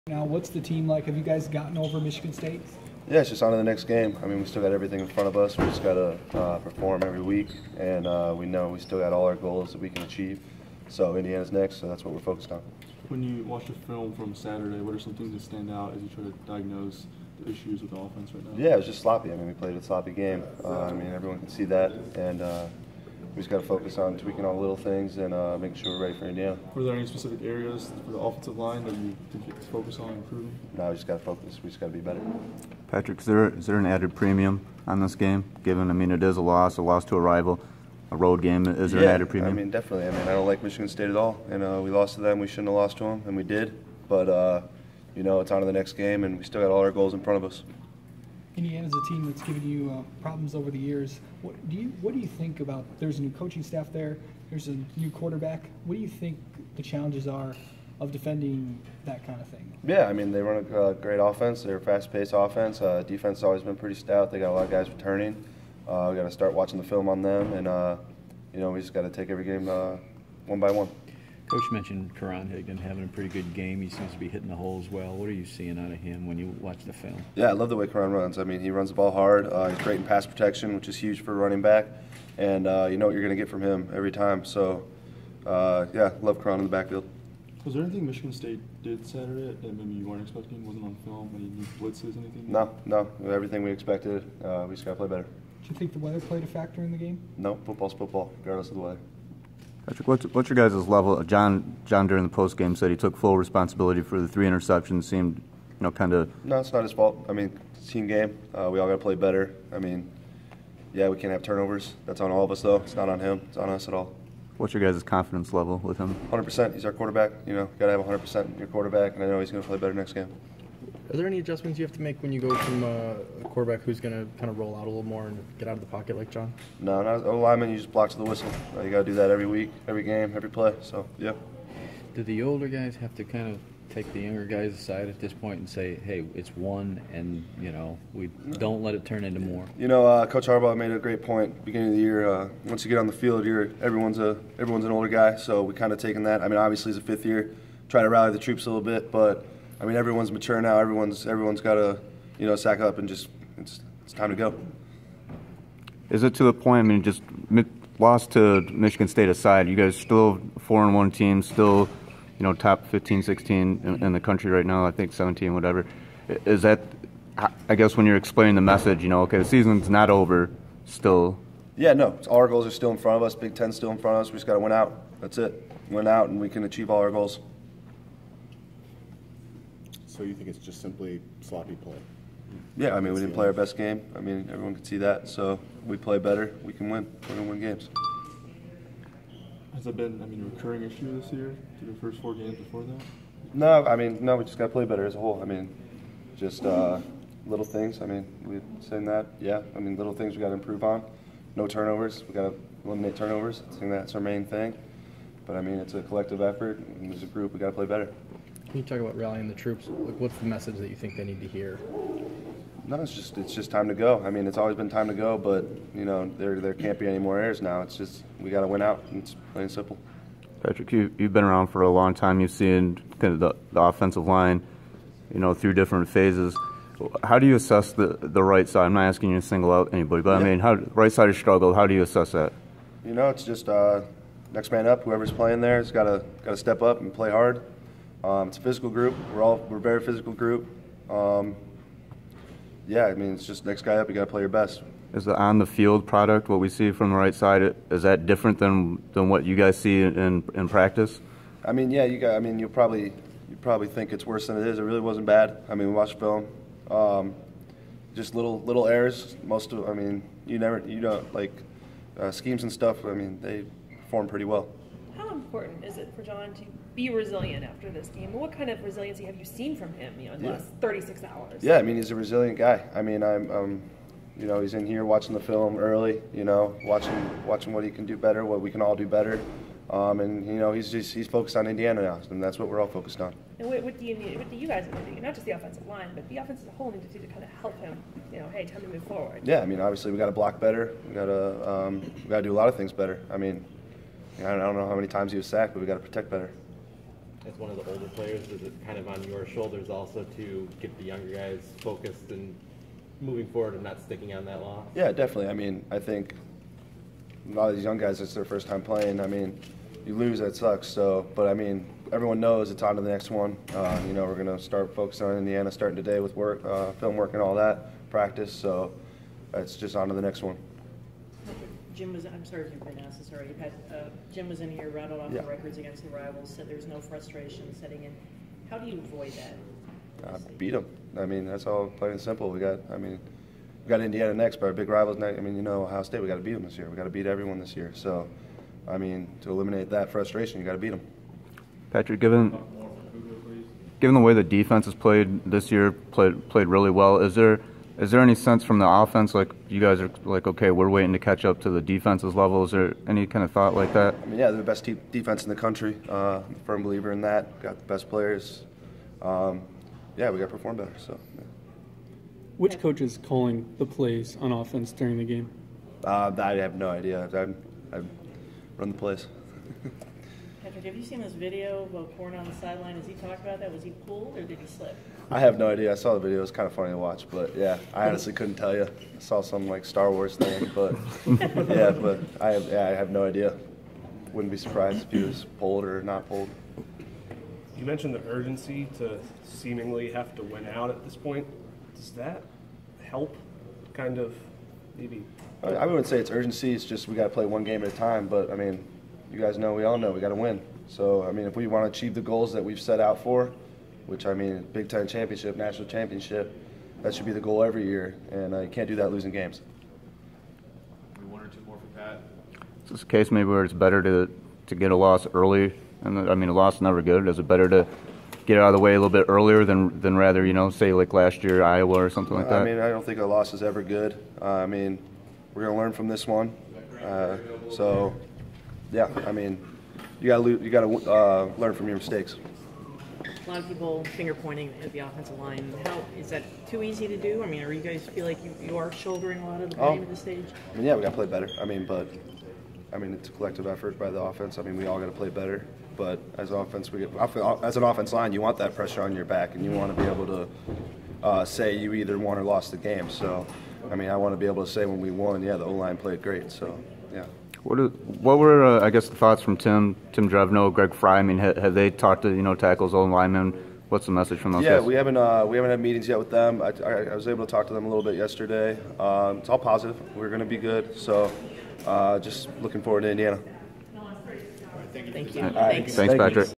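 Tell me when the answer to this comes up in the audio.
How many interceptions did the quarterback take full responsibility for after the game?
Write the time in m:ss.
1:44.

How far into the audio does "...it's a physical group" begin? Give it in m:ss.
3:58.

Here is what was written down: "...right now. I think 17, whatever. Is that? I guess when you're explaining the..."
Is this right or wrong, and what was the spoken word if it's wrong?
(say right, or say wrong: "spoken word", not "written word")
right.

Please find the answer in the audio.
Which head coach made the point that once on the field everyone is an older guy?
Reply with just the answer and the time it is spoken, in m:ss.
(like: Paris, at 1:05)
Coach Harbaugh, at 2:20.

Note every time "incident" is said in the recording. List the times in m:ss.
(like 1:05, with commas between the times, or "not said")
not said.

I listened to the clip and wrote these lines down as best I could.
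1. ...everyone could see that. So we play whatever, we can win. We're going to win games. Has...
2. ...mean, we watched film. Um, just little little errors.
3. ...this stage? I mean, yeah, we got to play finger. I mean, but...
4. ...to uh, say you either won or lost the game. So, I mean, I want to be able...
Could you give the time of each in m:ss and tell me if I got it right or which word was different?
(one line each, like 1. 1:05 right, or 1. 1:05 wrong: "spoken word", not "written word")
1. 3:04 wrong: "better", not "whatever"
2. 4:15 right
3. 7:20 wrong: "better", not "finger"
4. 7:30 right.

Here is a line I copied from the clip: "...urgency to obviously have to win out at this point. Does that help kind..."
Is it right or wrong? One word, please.
wrong.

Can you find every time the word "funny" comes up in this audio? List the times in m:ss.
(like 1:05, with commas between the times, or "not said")
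6:16.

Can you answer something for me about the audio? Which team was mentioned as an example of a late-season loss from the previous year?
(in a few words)
Iowa.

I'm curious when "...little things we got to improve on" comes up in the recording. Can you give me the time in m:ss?
3:19.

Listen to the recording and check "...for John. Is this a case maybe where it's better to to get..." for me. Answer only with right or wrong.
wrong.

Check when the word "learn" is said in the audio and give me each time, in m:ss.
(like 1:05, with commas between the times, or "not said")
7:05, 7:11.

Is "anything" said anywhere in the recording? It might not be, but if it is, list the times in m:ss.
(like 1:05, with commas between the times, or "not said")
1:27, 1:32.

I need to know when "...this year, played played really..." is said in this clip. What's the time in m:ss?
5:45.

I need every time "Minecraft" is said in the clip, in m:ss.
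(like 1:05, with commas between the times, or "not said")
not said.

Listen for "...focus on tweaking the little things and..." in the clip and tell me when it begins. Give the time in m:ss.
0:23.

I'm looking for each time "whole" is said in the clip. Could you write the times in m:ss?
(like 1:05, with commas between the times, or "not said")
3:15, 4:46.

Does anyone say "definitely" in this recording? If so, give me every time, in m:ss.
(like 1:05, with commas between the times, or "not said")
0:39, 5:05.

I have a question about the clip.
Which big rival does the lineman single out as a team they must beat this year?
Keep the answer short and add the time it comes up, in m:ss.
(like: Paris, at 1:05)
Ohio State, at 5:35.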